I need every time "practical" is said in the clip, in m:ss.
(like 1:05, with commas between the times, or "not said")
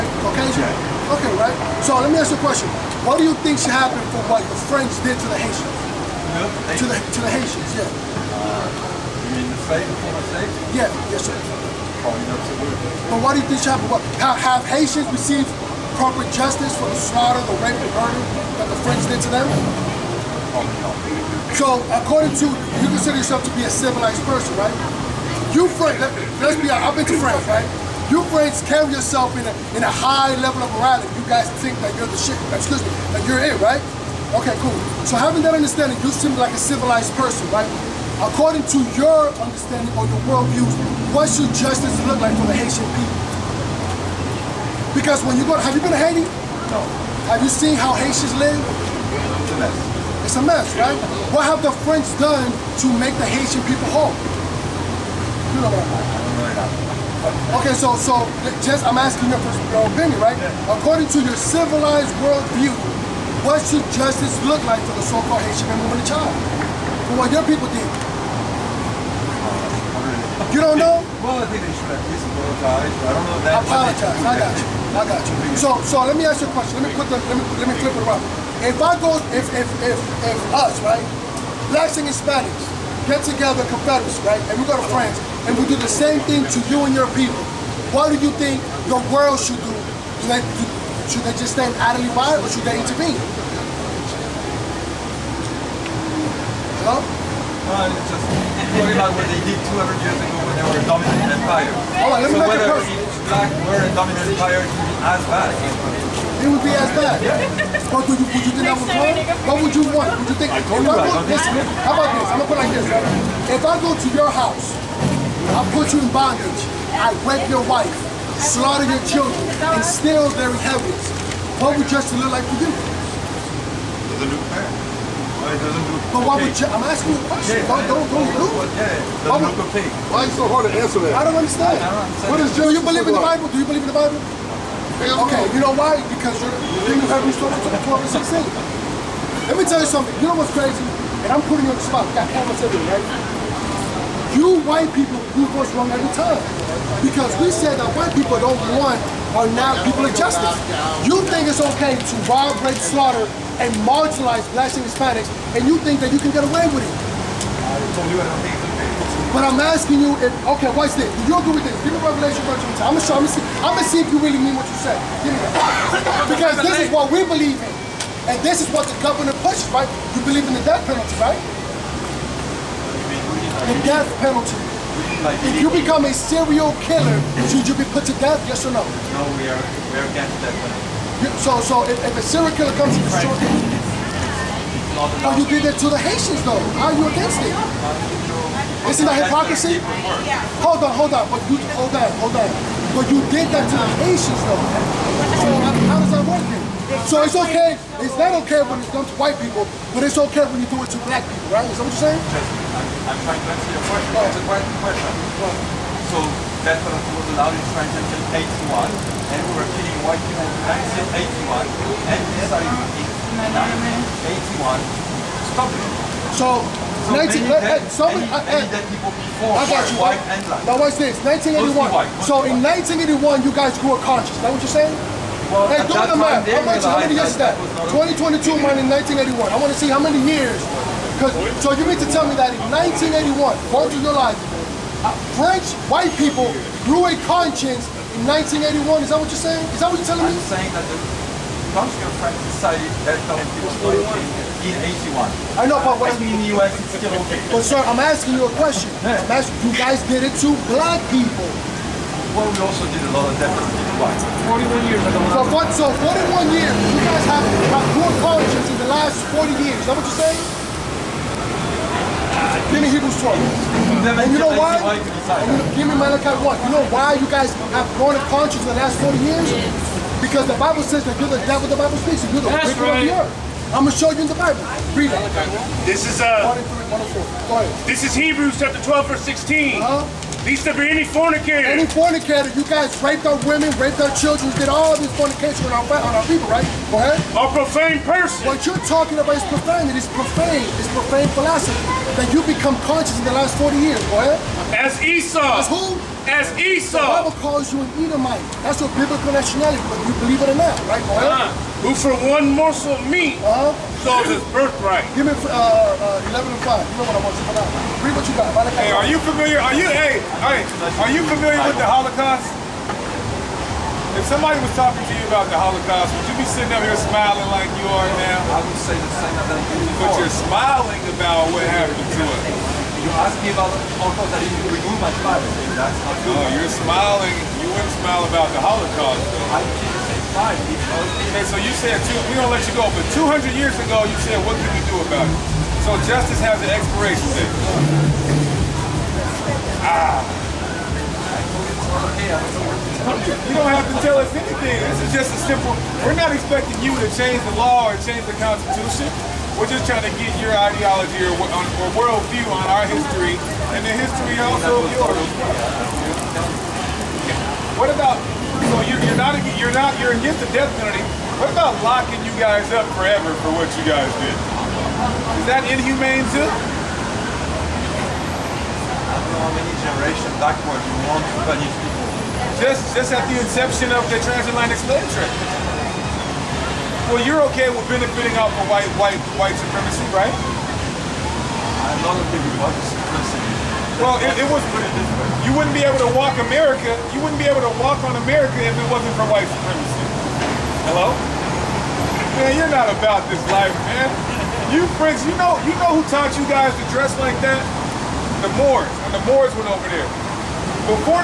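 not said.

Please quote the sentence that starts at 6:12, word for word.
Just, just at the inception of the transatlantic slave trade.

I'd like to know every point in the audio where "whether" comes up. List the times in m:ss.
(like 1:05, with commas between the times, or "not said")
1:42, 4:59.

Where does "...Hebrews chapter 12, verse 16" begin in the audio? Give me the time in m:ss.
4:38.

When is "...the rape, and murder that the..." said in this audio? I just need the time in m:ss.
0:17.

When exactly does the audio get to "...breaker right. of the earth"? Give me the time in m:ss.
4:32.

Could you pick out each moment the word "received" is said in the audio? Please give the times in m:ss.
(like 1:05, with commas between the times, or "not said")
0:15.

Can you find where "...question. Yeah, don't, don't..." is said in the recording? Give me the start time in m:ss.
2:07.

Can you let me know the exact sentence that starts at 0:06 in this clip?
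To the to the Haitians, yeah.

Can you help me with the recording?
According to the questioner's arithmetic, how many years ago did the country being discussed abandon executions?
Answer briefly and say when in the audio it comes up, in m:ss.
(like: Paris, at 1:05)
41, at 4:14.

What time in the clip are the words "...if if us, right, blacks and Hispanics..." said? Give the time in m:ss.
1:19.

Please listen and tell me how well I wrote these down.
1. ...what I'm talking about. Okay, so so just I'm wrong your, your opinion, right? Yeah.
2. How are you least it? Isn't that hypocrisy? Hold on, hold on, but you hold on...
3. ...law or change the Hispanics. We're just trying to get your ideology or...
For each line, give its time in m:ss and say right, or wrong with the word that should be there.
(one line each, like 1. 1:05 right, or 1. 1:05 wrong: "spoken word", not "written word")
1. 0:55 wrong: "asking", not "wrong"
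2. 3:06 wrong: "against", not "least"
3. 5:47 wrong: "Constitution", not "Hispanics".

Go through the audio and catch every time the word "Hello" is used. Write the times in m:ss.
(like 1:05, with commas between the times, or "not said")
1:36, 6:30.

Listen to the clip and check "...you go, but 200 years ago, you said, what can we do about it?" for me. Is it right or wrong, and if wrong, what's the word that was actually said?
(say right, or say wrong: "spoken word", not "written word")
right.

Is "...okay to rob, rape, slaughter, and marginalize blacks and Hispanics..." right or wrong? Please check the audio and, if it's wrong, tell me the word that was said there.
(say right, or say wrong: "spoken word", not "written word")
right.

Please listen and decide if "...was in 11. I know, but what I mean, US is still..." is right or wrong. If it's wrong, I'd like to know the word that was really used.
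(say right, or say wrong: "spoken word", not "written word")
wrong: "81", not "11".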